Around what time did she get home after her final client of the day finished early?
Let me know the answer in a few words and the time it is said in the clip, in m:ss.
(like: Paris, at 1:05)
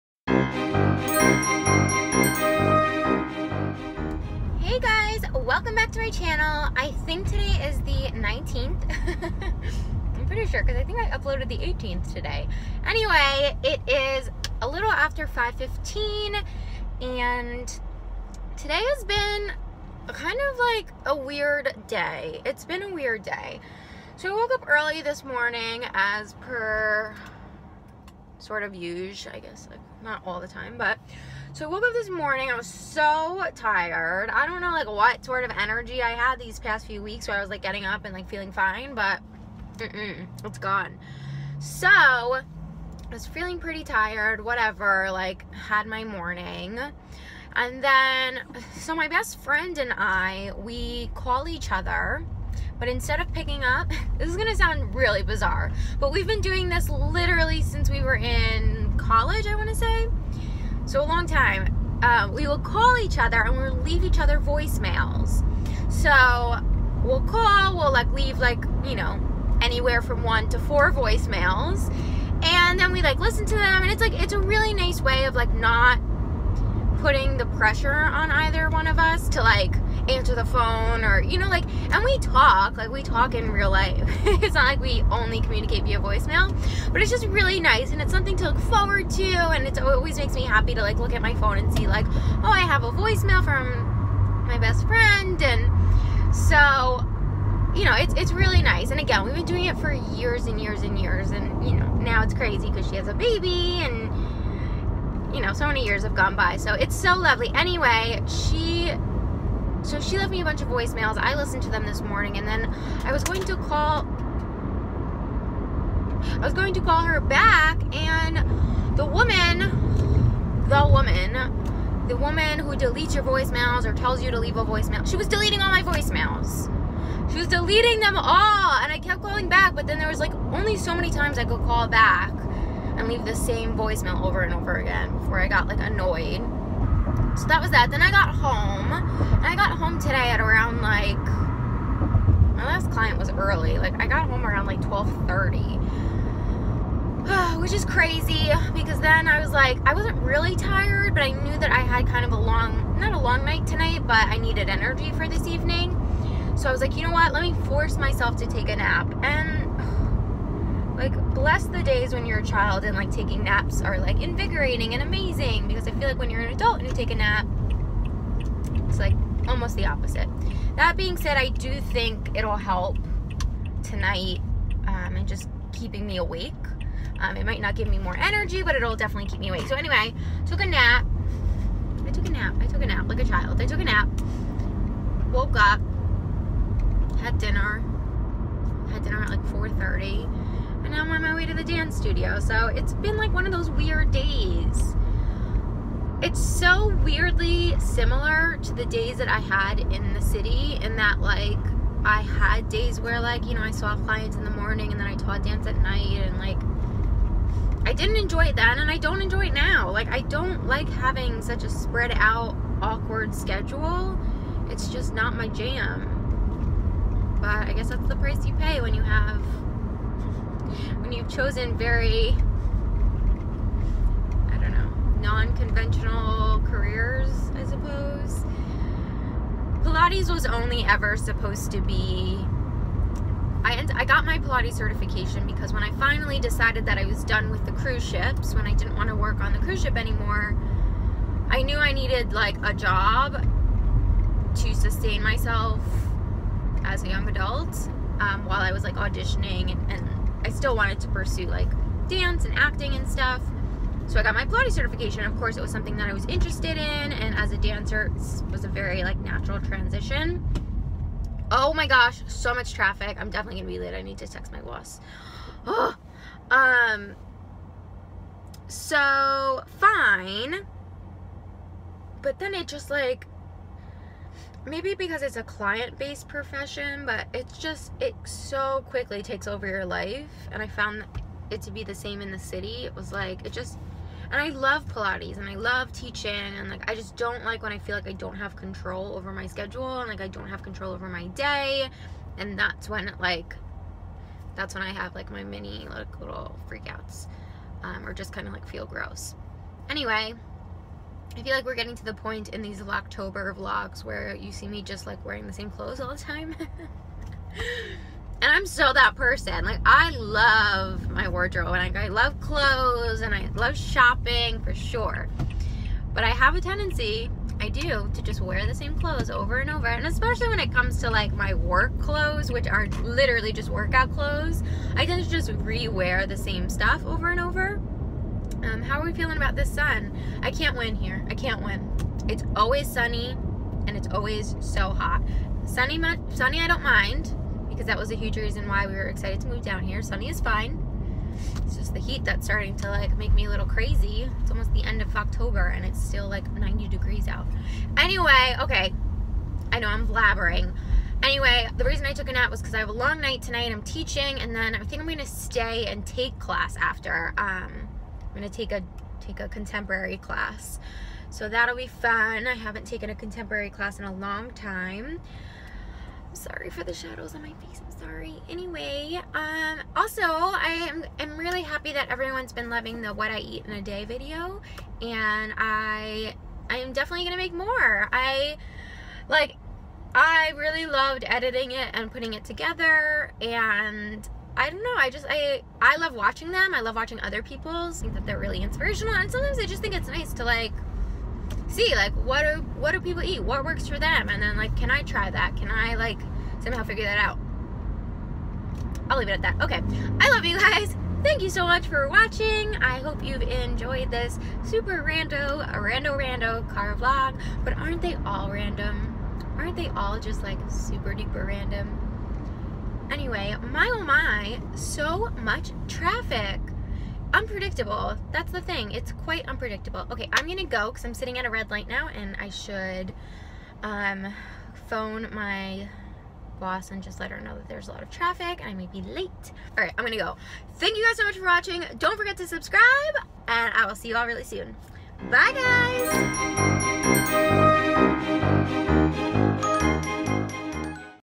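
12:30, at 2:24.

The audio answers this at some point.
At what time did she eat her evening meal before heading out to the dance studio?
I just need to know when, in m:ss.
3:09.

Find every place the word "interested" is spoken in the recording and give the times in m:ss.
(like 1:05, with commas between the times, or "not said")
4:16.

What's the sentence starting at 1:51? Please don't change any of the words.
I listened to them this morning, and then I was going to call.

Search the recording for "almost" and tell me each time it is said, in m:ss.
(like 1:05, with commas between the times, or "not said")
2:49, 5:44.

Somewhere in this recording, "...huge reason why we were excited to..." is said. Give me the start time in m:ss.
5:38.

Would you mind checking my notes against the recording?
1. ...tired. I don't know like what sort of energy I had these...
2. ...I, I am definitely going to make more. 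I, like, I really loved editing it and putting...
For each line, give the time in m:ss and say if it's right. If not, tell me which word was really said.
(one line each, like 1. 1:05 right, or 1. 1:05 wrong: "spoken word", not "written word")
1. 0:33 right
2. 6:15 right.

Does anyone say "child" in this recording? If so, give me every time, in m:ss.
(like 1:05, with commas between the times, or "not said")
2:42, 3:03.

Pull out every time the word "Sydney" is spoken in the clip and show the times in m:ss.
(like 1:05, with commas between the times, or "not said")
not said.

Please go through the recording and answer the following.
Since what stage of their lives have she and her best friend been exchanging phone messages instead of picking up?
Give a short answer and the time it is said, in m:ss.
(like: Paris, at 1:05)
College, at 0:58.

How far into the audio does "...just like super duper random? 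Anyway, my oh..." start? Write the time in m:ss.
6:50.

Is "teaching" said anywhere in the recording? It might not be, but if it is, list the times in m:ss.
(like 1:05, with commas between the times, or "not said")
4:45, 5:53.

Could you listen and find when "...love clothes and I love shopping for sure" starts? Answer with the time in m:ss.
5:12.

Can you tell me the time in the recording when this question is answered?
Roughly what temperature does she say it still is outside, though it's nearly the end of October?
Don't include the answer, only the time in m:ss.
5:46.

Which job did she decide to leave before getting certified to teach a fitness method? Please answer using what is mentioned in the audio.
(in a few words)
Cruise ships.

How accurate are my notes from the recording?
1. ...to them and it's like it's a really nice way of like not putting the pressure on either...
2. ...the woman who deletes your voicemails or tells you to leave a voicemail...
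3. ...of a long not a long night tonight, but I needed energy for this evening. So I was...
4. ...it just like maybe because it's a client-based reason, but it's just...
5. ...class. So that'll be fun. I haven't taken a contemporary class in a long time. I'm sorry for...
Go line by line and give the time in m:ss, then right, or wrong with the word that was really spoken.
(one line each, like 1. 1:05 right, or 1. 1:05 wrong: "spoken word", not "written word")
1. 1:13 right
2. 2:02 right
3. 2:32 right
4. 4:32 wrong: "profession", not "reason"
5. 6:00 right.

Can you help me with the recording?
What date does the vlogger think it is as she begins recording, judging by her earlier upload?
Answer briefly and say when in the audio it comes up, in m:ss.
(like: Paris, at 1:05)
19th, at 0:07.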